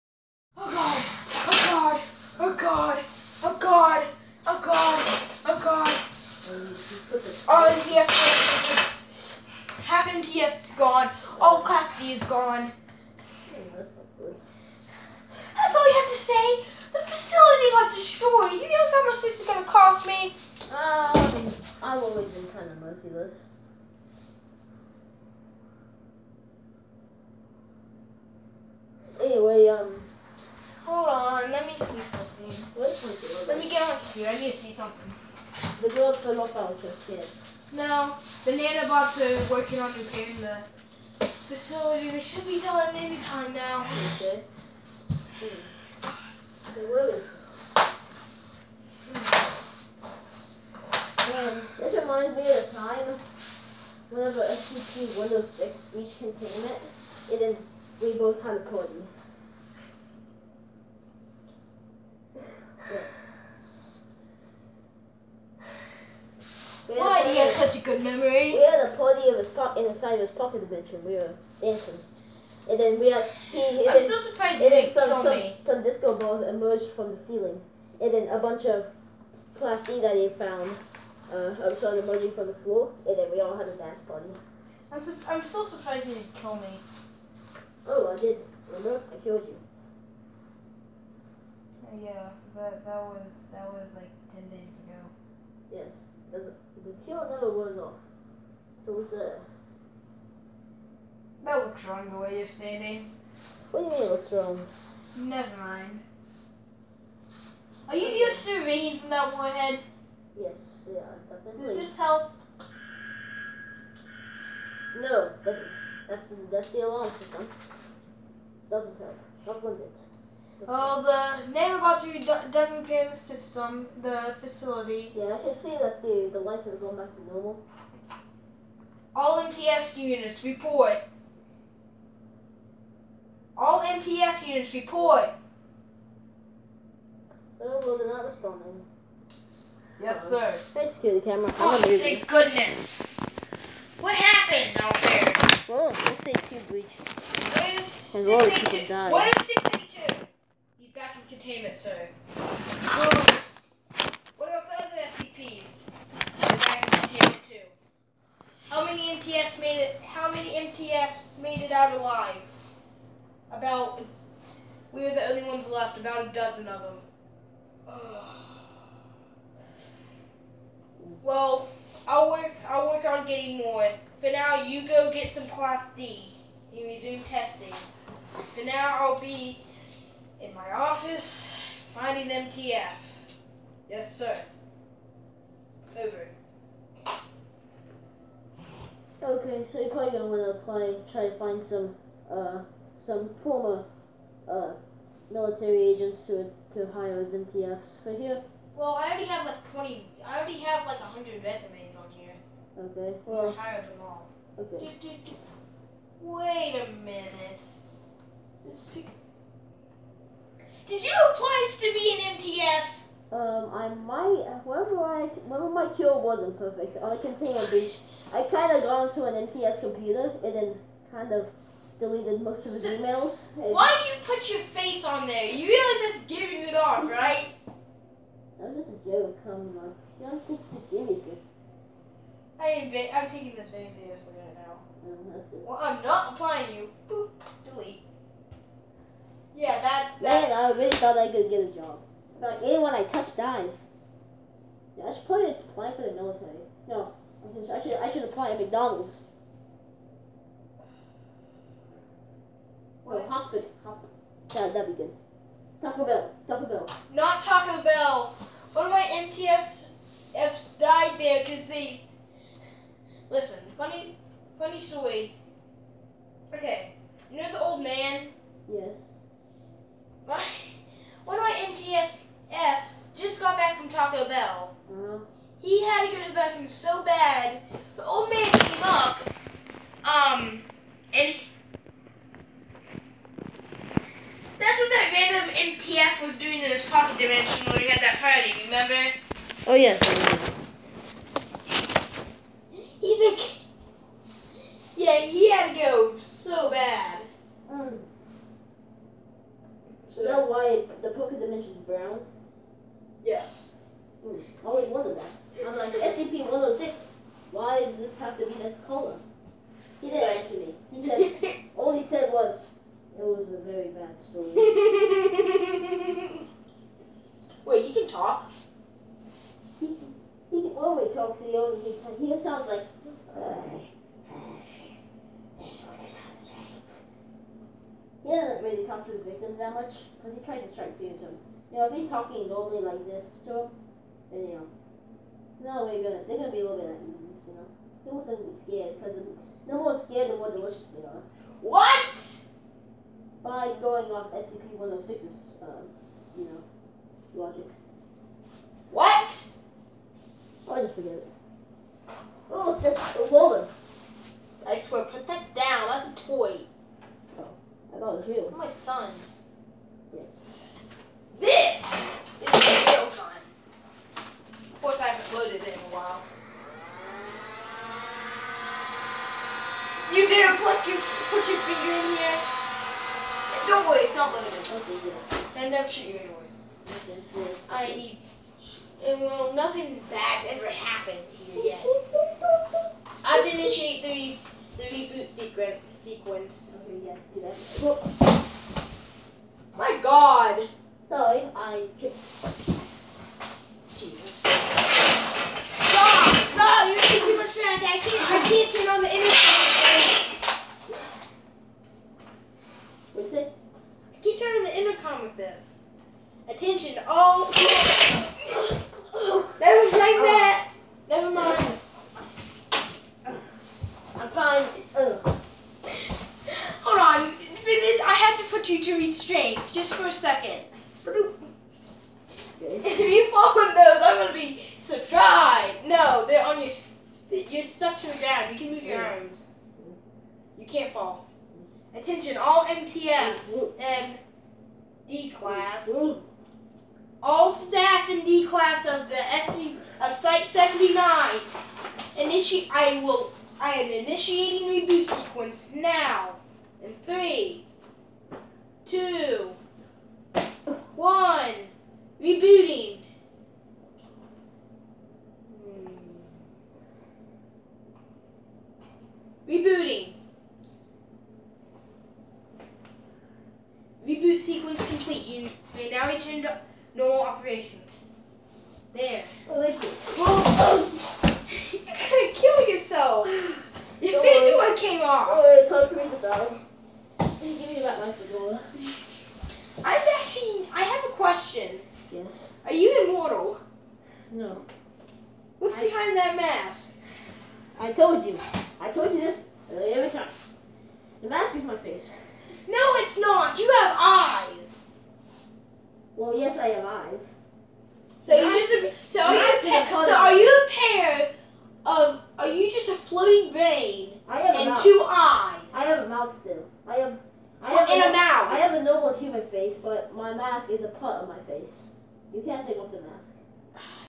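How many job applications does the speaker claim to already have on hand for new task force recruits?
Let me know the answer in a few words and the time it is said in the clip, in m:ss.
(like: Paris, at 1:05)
100, at 3:20.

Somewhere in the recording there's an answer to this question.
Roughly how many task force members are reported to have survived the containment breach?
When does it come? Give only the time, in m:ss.
2:45.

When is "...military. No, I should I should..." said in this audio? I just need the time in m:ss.
4:06.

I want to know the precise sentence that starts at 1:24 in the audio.
I'm su- I'm so surprised you didn't kill me.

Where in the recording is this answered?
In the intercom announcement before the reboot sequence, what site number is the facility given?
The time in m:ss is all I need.
7:20.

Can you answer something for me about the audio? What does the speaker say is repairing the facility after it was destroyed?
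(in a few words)
Nanobots.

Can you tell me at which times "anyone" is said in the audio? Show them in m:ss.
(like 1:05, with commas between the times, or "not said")
4:02.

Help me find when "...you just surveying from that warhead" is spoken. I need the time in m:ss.
1:47.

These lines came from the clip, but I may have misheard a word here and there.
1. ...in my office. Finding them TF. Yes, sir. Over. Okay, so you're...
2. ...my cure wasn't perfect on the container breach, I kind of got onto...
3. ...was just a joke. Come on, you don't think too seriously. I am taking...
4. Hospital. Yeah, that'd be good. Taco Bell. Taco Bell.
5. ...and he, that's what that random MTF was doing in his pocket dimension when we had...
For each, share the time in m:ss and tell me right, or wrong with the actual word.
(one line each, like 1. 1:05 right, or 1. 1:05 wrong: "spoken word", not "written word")
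1. 3:00 right
2. 3:35 right
3. 3:48 right
4. 4:13 right
5. 4:41 right.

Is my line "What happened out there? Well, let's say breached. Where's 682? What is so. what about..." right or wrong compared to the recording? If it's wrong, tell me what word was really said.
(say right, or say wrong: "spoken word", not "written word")
right.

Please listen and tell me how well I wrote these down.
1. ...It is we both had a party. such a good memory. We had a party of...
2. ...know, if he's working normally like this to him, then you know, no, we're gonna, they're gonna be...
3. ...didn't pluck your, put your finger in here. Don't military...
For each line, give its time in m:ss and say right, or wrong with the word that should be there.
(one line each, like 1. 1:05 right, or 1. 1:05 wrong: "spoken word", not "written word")
1. 0:57 right
2. 5:31 wrong: "talking", not "working"
3. 6:10 wrong: "worry", not "military".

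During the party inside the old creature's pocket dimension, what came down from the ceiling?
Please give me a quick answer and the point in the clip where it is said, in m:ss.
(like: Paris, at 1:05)
Disco balls, at 1:15.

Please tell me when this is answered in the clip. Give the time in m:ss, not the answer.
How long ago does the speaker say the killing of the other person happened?
1:34.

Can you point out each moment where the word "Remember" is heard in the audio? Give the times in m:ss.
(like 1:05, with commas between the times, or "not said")
1:28, 4:48.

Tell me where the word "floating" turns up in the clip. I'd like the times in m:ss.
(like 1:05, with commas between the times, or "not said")
8:22.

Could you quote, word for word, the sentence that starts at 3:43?
Why'd you put your face on there?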